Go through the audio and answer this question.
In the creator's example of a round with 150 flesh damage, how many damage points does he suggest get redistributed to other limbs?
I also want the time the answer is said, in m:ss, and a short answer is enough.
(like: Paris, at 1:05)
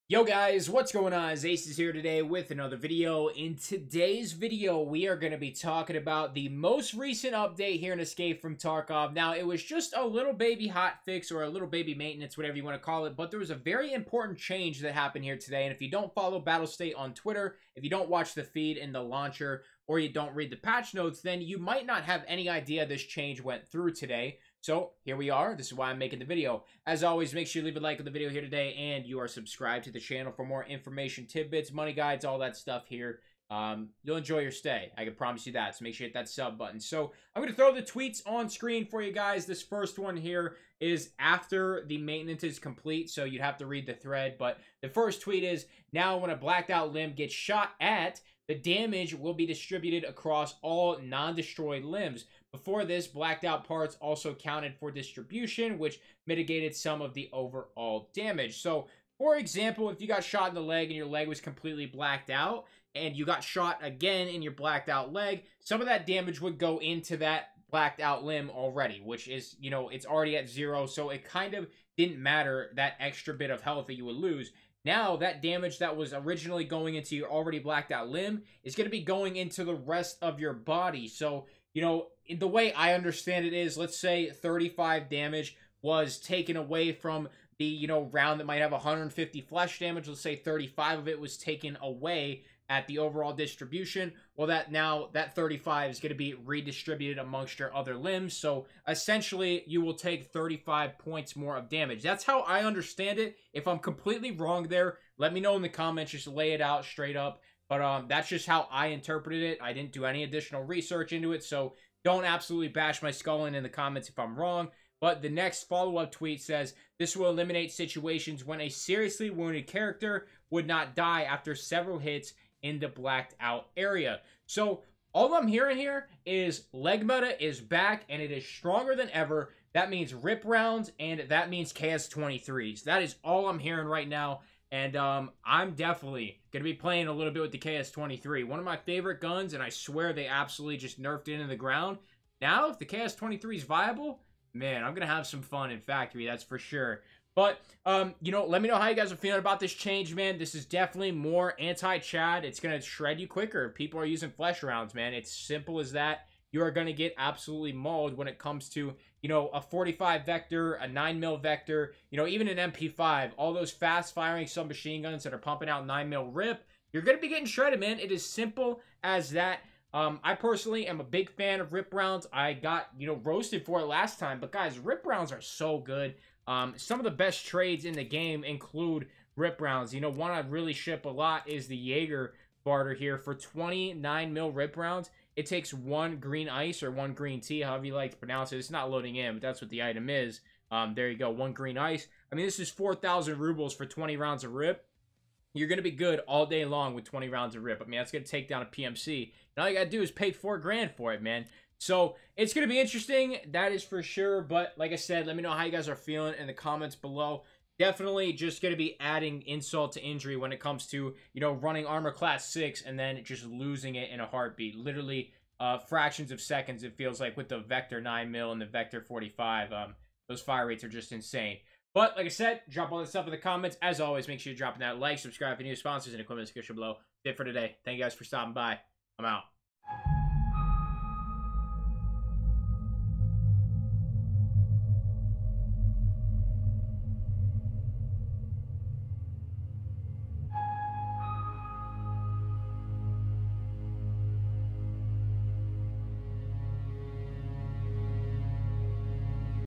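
35, at 1:40.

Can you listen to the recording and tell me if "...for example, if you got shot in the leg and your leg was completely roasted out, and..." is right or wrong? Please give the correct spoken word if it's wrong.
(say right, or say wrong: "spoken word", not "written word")
wrong: "blacked", not "roasted".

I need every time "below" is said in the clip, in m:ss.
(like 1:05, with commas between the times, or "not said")
3:26, 3:46.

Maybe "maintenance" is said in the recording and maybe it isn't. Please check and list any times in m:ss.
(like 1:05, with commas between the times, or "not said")
0:11, 0:41.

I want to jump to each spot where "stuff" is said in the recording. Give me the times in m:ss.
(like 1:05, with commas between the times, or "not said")
0:32, 3:43.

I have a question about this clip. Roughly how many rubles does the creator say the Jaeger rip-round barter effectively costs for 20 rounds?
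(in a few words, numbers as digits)
4,000 rubles.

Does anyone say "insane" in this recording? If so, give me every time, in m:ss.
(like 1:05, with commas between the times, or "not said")
3:41.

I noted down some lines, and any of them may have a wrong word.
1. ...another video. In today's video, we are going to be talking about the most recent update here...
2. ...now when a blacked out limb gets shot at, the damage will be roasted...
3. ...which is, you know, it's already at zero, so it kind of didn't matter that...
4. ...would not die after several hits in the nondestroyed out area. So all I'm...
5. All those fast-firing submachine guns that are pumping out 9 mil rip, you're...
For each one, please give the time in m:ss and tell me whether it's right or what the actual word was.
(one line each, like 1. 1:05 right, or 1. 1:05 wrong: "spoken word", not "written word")
1. 0:02 right
2. 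0:45 wrong: "distributed", not "roasted"
3. 1:08 right
4. 2:00 wrong: "blacked", not "nondestroyed"
5. 2:43 right.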